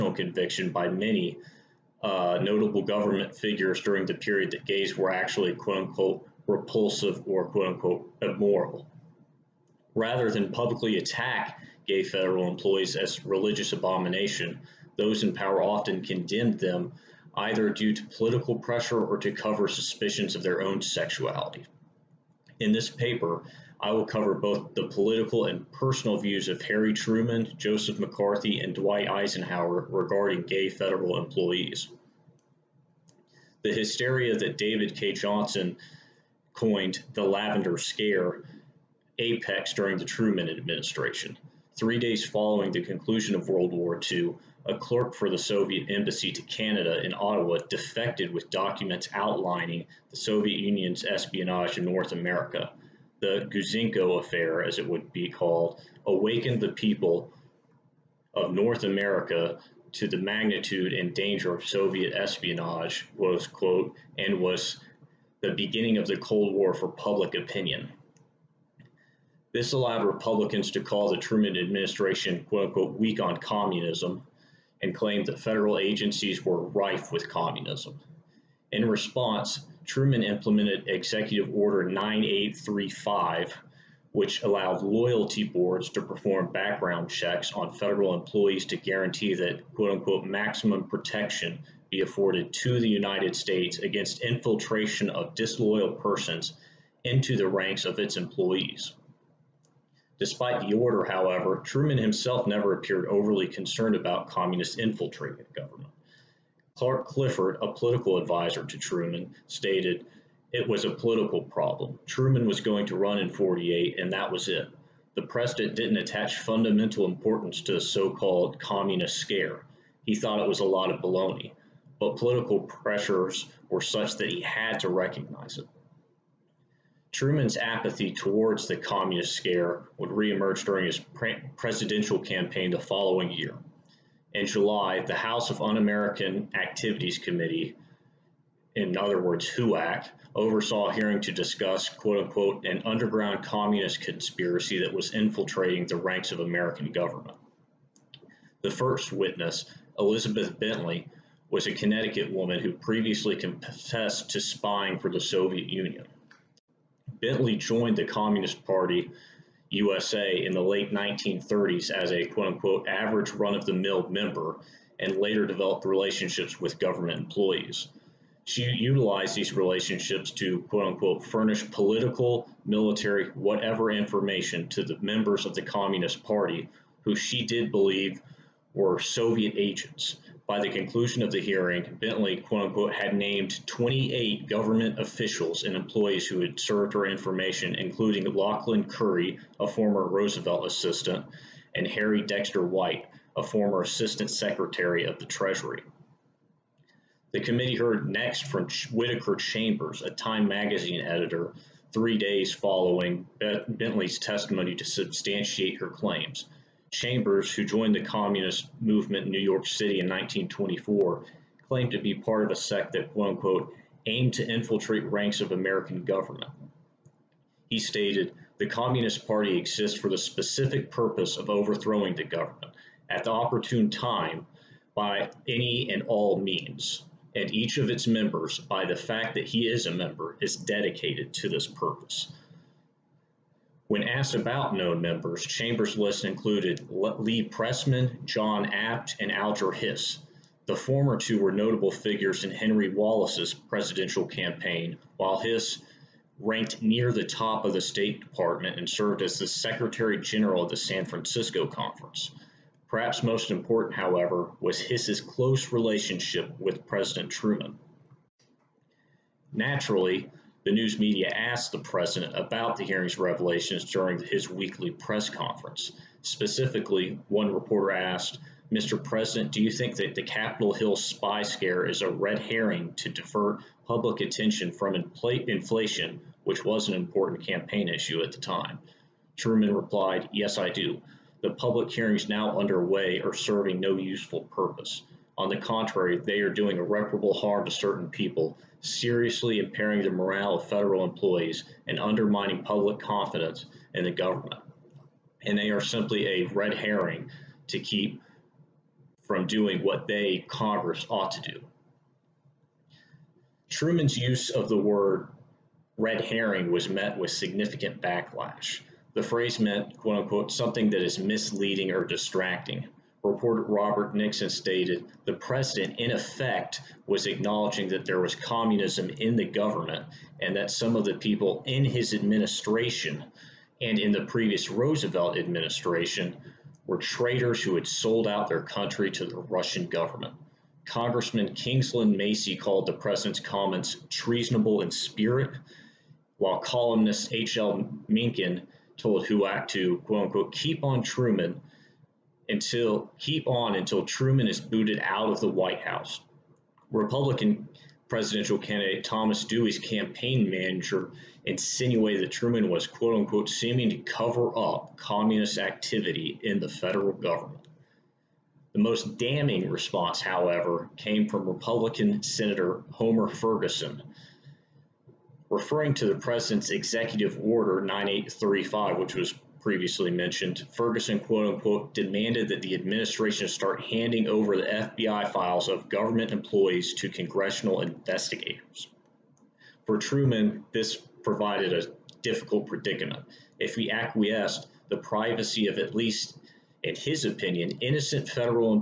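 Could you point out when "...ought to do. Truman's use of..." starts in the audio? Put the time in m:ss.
5:01.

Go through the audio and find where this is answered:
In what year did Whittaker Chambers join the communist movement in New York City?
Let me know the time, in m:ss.
3:30.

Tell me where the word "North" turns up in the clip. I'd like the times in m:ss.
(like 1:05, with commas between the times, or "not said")
0:51, 0:58.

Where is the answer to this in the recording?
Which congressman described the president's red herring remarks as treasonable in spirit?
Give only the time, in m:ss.
5:31.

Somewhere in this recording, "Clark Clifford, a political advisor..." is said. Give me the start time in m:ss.
1:46.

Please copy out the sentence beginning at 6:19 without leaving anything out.
For Truman, this provided a difficult predicament.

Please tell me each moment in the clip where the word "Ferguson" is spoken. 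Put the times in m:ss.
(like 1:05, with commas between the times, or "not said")
6:03, 6:10.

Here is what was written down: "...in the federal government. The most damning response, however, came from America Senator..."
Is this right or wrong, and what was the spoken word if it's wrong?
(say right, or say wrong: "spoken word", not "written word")
wrong: "Republican", not "America".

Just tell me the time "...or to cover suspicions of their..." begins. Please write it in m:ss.
0:19.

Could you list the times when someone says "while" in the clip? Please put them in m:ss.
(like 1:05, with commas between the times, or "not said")
4:05, 5:36.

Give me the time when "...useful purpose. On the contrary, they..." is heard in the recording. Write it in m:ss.
4:43.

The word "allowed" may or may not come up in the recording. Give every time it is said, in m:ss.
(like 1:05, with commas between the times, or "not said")
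1:09, 1:24.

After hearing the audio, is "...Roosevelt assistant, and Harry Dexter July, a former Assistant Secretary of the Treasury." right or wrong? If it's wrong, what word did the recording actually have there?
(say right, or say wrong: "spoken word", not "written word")
wrong: "White", not "July".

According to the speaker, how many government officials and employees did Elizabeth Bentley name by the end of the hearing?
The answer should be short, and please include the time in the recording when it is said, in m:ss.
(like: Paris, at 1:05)
28, at 3:03.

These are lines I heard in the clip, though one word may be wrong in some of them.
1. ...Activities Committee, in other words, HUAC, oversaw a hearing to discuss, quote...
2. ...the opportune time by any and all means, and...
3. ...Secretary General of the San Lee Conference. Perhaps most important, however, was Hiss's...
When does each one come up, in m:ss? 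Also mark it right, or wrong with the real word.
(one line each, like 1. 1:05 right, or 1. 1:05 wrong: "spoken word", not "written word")
1. 2:16 right
2. 3:43 right
3. 4:09 wrong: "Francisco", not "Lee".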